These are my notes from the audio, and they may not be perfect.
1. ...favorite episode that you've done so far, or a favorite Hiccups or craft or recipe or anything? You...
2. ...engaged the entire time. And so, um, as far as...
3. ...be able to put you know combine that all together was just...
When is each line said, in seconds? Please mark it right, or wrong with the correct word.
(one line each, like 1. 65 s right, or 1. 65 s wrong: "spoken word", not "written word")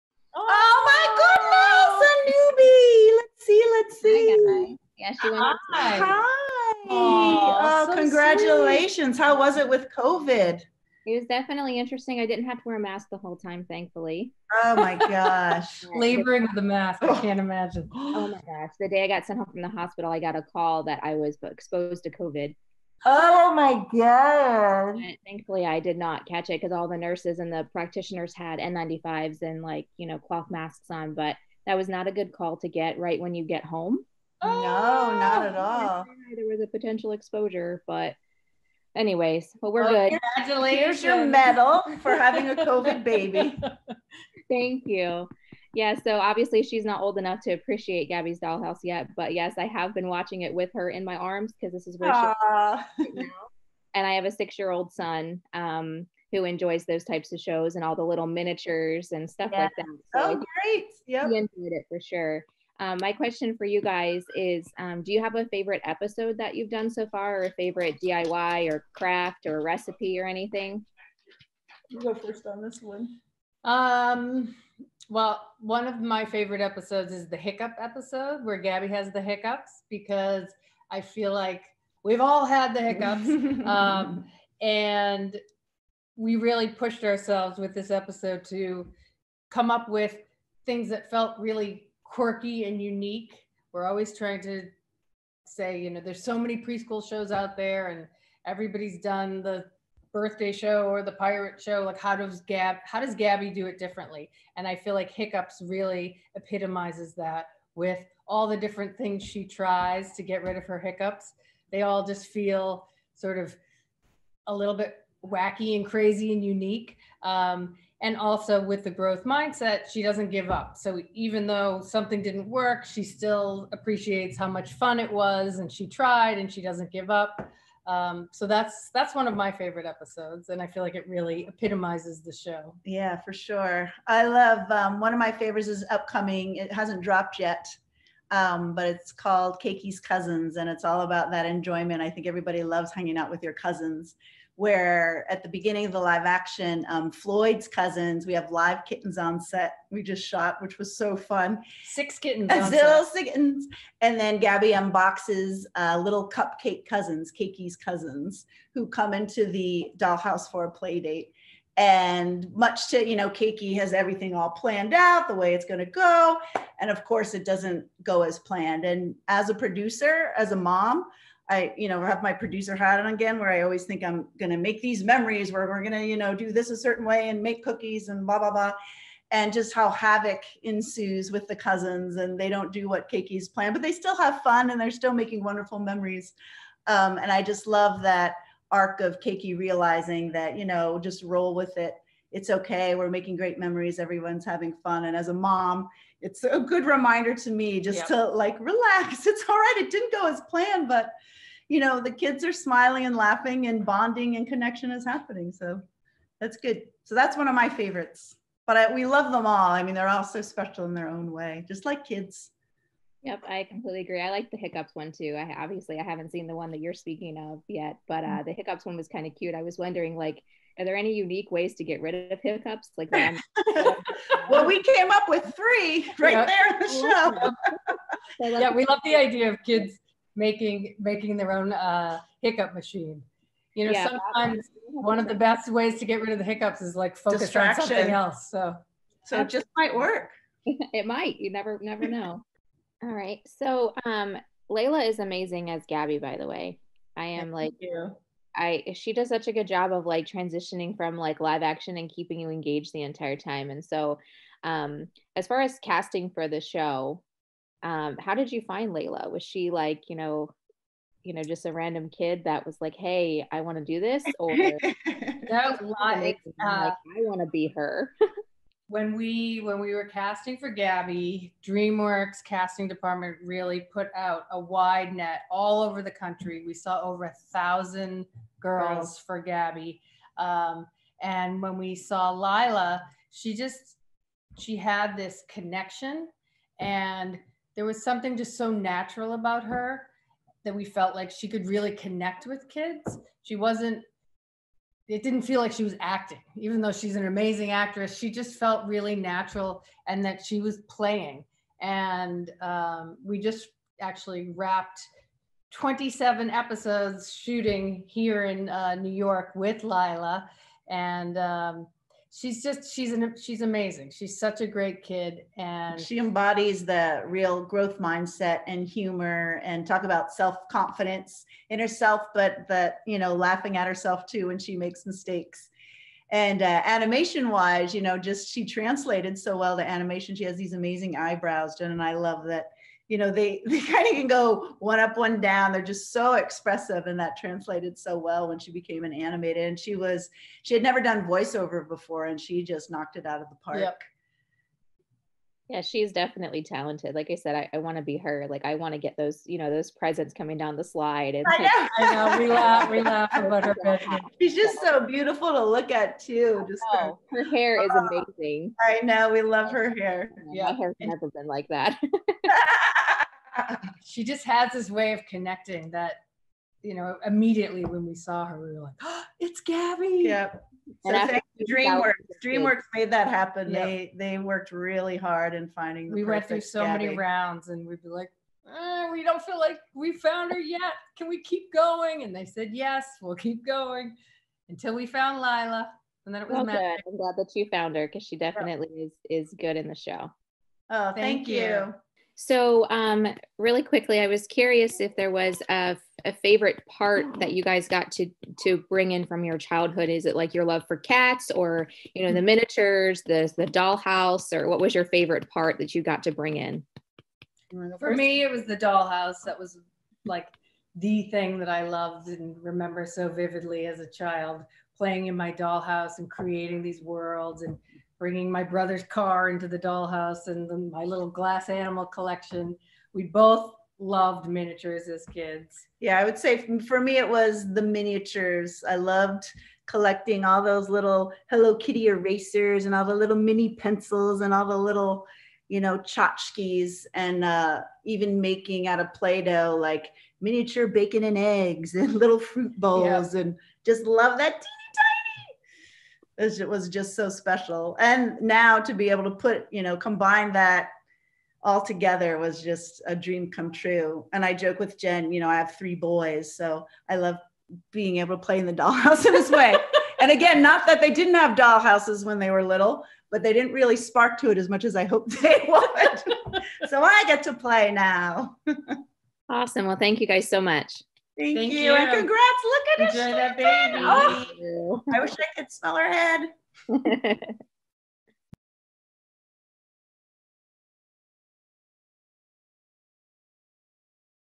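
1. 65 s wrong: "DIY", not "Hiccups"
2. 252 s right
3. 448 s right.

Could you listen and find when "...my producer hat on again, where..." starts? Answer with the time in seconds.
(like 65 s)
172 s.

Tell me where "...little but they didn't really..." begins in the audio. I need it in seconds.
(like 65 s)
462 s.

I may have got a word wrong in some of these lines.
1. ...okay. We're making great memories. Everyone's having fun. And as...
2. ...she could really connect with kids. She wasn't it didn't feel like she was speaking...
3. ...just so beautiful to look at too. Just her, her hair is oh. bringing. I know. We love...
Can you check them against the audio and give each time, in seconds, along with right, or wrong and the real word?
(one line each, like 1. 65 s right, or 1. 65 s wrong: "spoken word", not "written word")
1. 192 s right
2. 291 s wrong: "acting", not "speaking"
3. 354 s wrong: "amazing", not "bringing".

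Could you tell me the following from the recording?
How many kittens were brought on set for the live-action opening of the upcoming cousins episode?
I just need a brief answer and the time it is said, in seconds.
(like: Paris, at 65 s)
6, at 151 s.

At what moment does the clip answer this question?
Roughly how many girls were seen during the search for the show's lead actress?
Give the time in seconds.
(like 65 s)
277 s.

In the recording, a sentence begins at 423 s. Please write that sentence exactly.
We both loved miniatures as kids.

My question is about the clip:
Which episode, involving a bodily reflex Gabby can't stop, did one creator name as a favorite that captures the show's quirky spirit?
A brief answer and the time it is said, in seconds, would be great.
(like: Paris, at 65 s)
The hiccup episode, at 77 s.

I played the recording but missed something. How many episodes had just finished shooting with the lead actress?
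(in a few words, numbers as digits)
27.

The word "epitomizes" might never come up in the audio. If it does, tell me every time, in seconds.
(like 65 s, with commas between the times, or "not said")
106 s, 131 s.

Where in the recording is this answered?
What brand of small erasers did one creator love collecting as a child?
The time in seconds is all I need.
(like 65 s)
431 s.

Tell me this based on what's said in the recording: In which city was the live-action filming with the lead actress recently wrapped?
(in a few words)
New York.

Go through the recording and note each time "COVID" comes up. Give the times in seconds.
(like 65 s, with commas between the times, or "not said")
9 s, 22 s, 42 s.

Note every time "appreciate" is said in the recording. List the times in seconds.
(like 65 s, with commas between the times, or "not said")
47 s, 123 s.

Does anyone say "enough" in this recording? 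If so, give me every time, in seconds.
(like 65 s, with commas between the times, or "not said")
47 s.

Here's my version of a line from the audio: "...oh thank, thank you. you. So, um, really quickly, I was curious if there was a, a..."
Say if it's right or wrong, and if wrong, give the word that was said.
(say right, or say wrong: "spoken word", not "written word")
right.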